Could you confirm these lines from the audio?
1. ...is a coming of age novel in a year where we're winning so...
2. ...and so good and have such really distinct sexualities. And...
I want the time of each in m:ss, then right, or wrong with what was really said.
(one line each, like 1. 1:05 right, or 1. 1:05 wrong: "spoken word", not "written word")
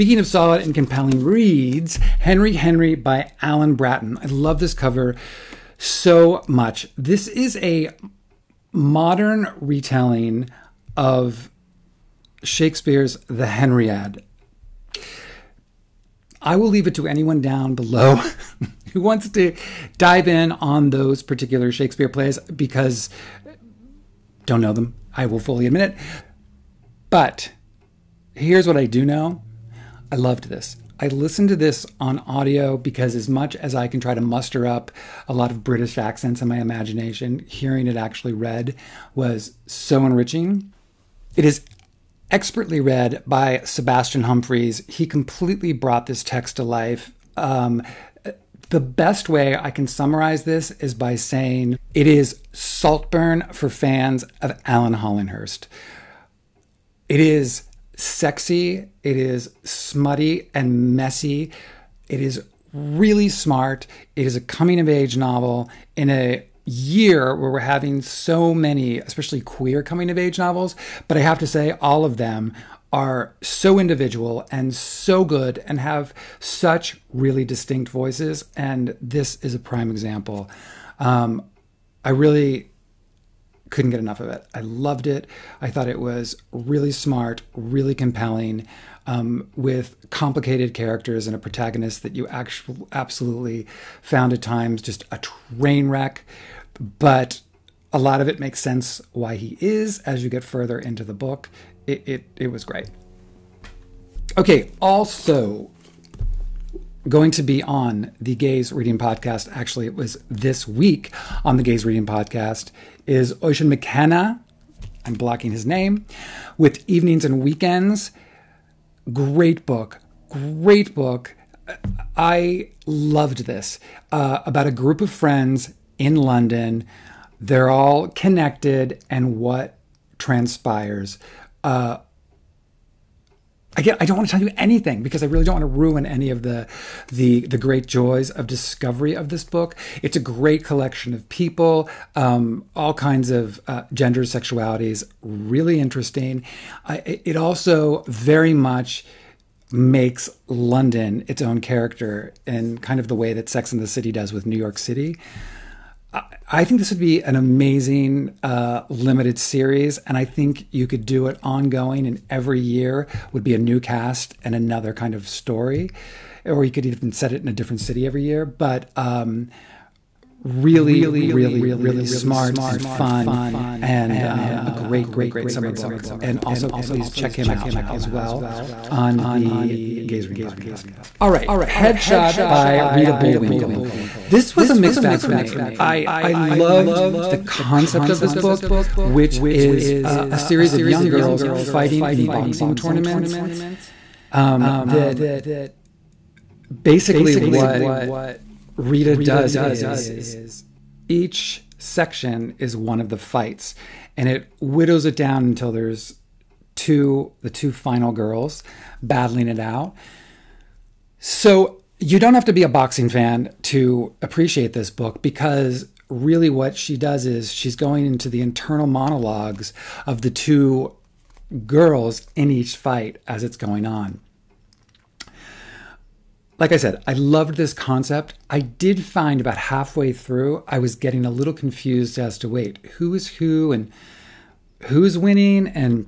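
1. 1:04 wrong: "having", not "winning"
2. 1:14 wrong: "voices", not "sexualities".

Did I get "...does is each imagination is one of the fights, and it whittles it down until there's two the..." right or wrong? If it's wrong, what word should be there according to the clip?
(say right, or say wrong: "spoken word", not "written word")
wrong: "section", not "imagination".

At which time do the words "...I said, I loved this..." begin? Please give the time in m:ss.
3:46.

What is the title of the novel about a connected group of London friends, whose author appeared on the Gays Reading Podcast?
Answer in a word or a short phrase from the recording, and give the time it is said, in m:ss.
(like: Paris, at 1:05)
Evenings and Weekends, at 1:56.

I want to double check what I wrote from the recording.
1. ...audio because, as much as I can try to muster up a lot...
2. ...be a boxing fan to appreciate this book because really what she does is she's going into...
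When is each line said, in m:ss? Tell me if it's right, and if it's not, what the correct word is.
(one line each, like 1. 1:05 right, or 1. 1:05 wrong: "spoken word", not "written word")
1. 0:32 right
2. 3:32 right.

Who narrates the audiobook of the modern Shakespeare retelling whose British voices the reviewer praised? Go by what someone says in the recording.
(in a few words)
Sebastian Humphreys.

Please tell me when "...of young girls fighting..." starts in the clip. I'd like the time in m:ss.
3:10.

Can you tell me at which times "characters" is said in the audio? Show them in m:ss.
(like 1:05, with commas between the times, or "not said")
1:30, 2:31.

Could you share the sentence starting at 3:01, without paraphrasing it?
All right, Headshot by Rita Bullwinkel.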